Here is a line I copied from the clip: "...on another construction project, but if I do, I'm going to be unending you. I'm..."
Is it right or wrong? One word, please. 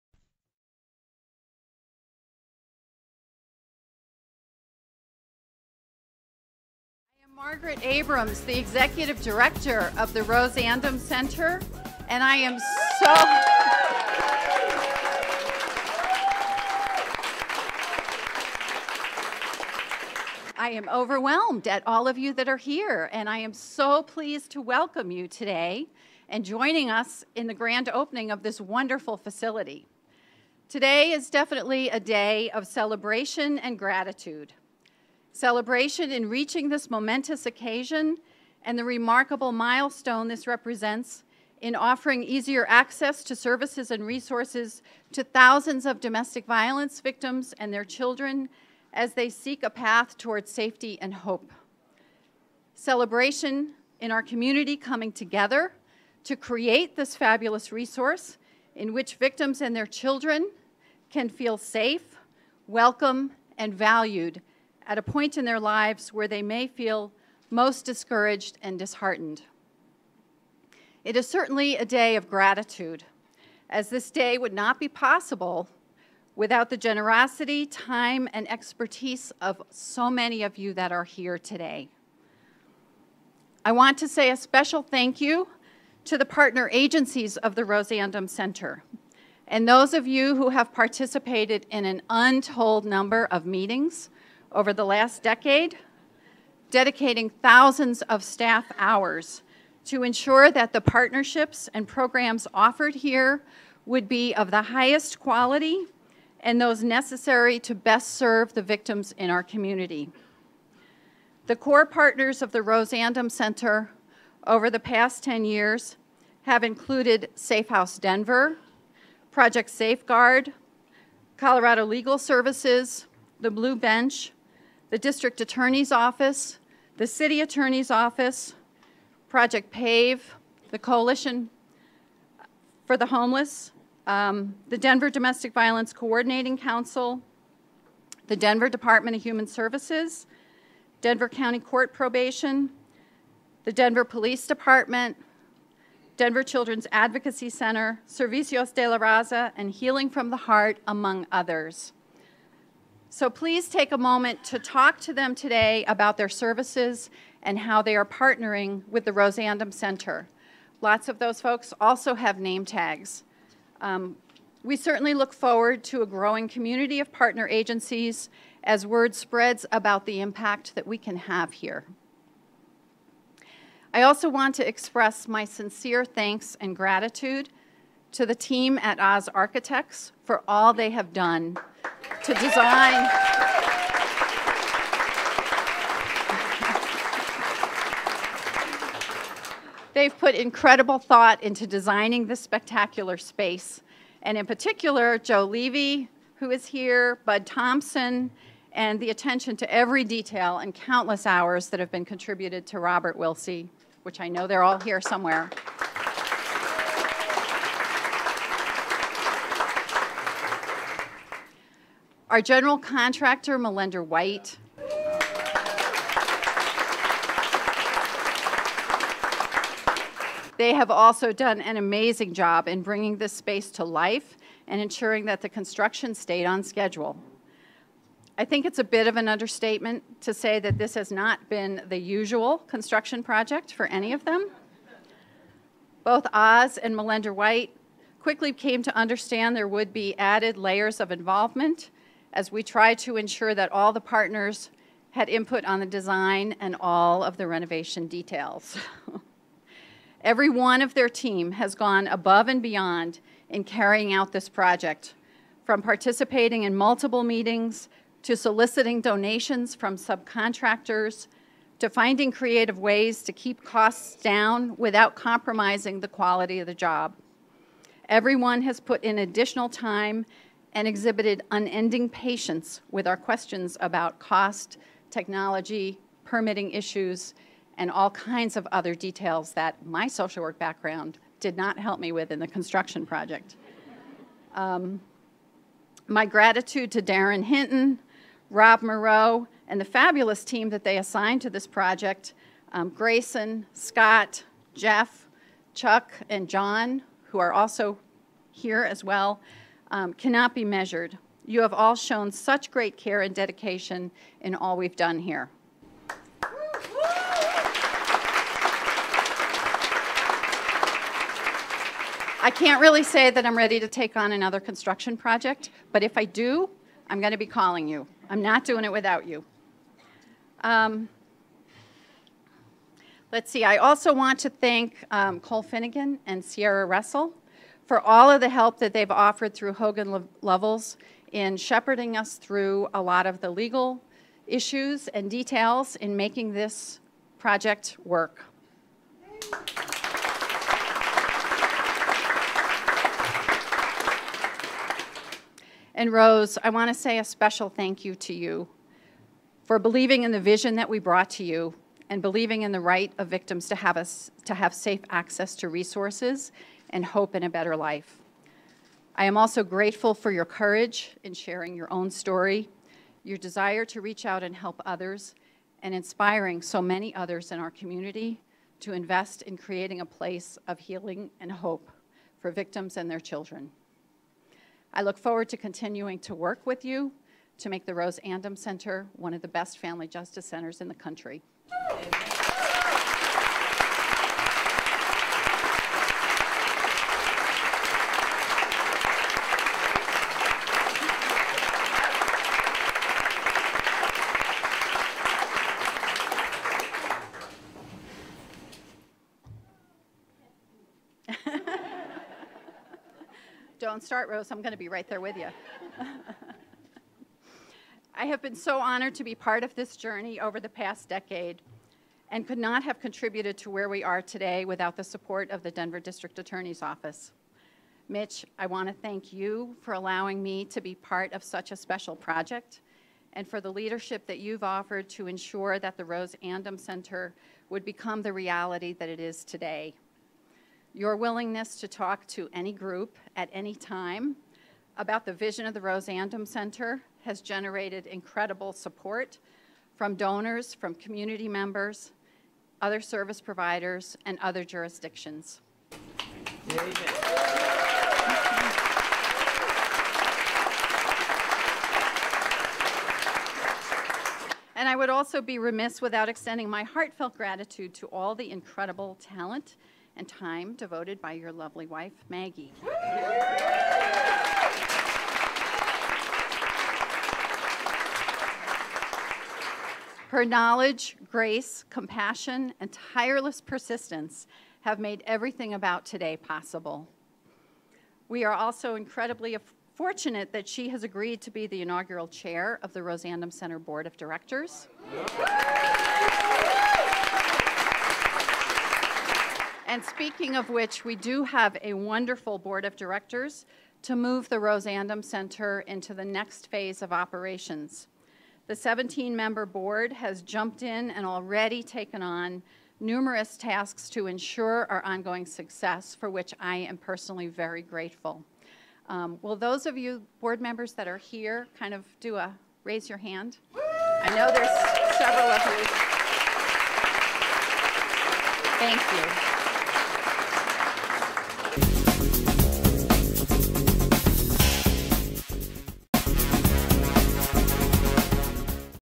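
wrong.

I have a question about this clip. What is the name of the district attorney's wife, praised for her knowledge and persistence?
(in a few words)
Maggie.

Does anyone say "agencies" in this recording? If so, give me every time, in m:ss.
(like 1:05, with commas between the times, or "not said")
1:26, 2:47.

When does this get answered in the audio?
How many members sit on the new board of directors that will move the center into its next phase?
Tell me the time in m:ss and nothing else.
8:18.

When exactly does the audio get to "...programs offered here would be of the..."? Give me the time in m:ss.
1:41.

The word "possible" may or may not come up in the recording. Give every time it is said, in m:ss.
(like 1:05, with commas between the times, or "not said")
1:14, 7:56.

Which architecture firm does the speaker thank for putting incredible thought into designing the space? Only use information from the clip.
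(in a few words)
Oz Architects.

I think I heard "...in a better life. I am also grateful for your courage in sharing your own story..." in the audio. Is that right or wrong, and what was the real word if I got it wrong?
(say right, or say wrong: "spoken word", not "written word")
right.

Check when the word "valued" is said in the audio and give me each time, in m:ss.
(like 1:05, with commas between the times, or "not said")
1:03.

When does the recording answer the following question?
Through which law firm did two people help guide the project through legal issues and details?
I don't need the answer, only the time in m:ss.
5:29.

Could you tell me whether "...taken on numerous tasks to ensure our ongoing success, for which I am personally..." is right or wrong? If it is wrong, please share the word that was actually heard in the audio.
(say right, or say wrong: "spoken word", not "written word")
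right.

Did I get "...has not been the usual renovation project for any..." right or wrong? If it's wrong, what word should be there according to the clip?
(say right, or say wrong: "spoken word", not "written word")
wrong: "construction", not "renovation".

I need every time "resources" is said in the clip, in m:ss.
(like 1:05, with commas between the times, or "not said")
0:44, 0:57, 5:55.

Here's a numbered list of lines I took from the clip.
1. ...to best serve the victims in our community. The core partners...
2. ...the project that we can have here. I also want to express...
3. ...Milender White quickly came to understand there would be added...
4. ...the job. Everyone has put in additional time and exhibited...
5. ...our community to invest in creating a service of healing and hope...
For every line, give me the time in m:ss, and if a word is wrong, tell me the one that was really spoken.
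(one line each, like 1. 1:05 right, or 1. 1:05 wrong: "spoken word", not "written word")
1. 1:47 right
2. 2:50 wrong: "impact", not "project"
3. 3:56 right
4. 4:26 right
5. 6:07 wrong: "place", not "service".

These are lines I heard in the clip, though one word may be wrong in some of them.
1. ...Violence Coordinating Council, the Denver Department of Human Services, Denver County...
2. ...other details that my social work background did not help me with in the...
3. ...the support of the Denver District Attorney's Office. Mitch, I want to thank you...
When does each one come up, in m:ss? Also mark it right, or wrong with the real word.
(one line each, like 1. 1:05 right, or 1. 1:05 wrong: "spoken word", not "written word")
1. 2:15 right
2. 4:38 right
3. 6:54 right.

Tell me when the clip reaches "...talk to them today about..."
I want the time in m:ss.
2:34.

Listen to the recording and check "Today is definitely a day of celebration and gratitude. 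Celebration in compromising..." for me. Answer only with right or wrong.
wrong.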